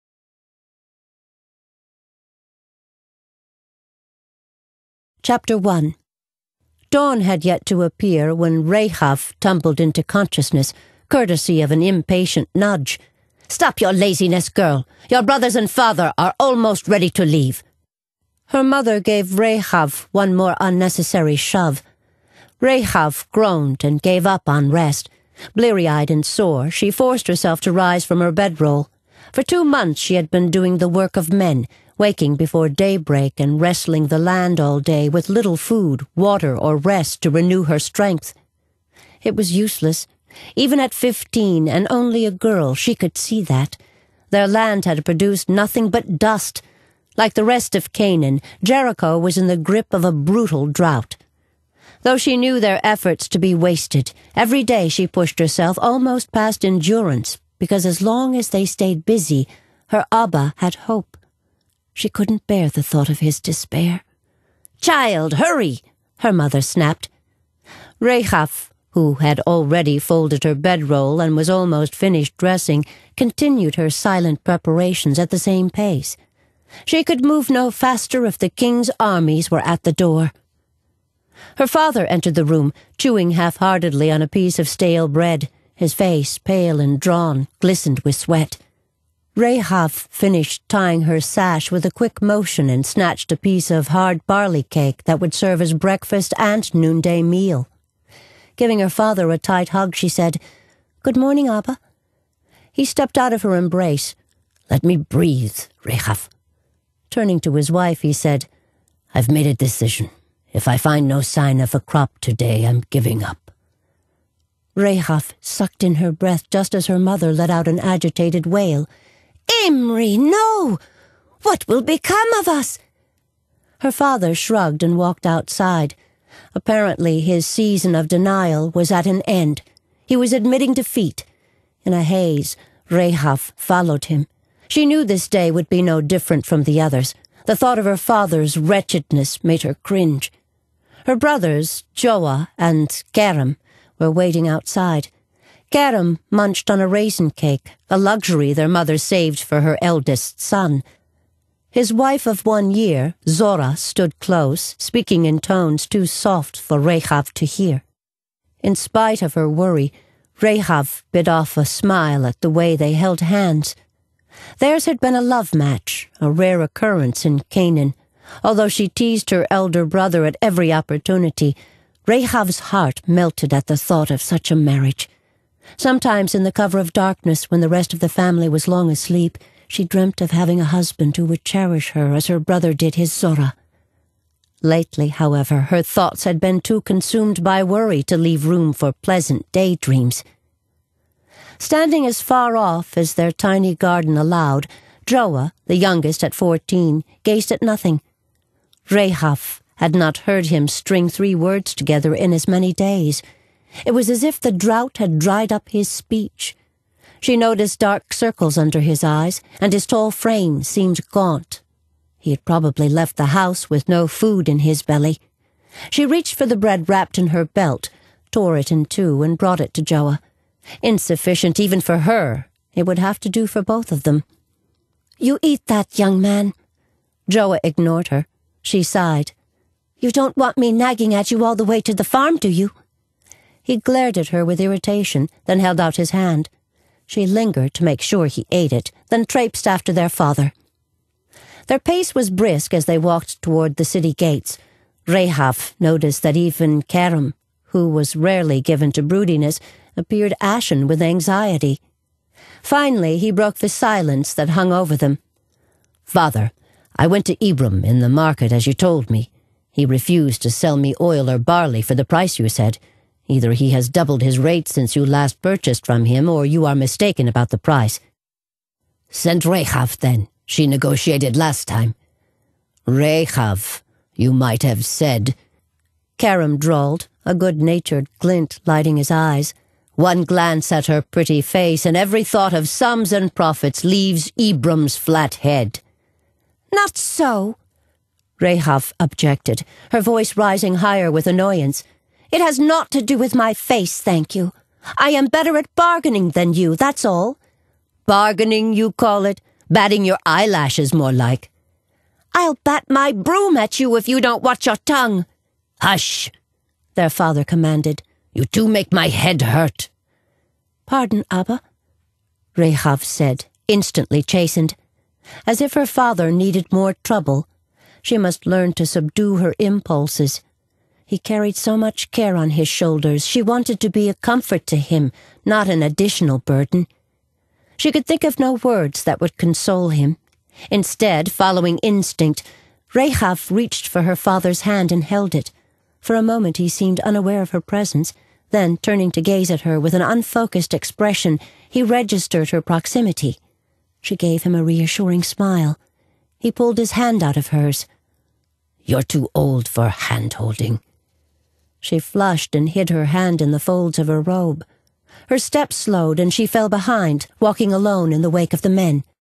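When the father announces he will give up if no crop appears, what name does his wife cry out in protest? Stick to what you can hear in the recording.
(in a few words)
Imri.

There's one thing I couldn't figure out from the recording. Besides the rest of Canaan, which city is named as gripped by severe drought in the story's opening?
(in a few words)
Jericho.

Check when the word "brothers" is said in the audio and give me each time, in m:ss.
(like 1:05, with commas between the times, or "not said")
0:15, 2:21, 2:49, 3:02.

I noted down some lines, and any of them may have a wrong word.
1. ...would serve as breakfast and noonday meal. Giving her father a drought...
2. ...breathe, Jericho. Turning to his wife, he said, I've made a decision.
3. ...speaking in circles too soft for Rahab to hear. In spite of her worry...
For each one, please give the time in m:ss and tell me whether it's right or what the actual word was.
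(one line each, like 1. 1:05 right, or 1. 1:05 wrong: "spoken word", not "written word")
1. 1:35 wrong: "tight", not "drought"
2. 1:44 wrong: "Rahab", not "Jericho"
3. 2:34 wrong: "tones", not "circles".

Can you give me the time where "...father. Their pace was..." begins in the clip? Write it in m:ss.
4:00.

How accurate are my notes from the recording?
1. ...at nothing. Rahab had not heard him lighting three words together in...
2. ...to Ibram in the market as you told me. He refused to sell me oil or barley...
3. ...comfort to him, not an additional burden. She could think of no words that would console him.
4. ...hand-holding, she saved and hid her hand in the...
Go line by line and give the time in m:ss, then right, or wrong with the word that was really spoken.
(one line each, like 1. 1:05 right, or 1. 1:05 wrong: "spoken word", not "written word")
1. 3:17 wrong: "string", not "lighting"
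2. 4:17 right
3. 5:24 right
4. 5:49 wrong: "flushed", not "saved".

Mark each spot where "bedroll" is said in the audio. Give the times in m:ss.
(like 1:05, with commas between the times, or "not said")
0:28, 1:10.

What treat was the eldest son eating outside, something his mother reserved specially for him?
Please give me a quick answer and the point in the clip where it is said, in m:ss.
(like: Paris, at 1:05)
raisin cake, at 2:26.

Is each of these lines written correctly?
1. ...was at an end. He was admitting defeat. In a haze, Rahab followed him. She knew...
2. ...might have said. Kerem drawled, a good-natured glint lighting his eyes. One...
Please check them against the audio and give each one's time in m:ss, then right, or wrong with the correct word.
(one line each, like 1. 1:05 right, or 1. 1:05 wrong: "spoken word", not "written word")
1. 2:08 right
2. 4:34 right.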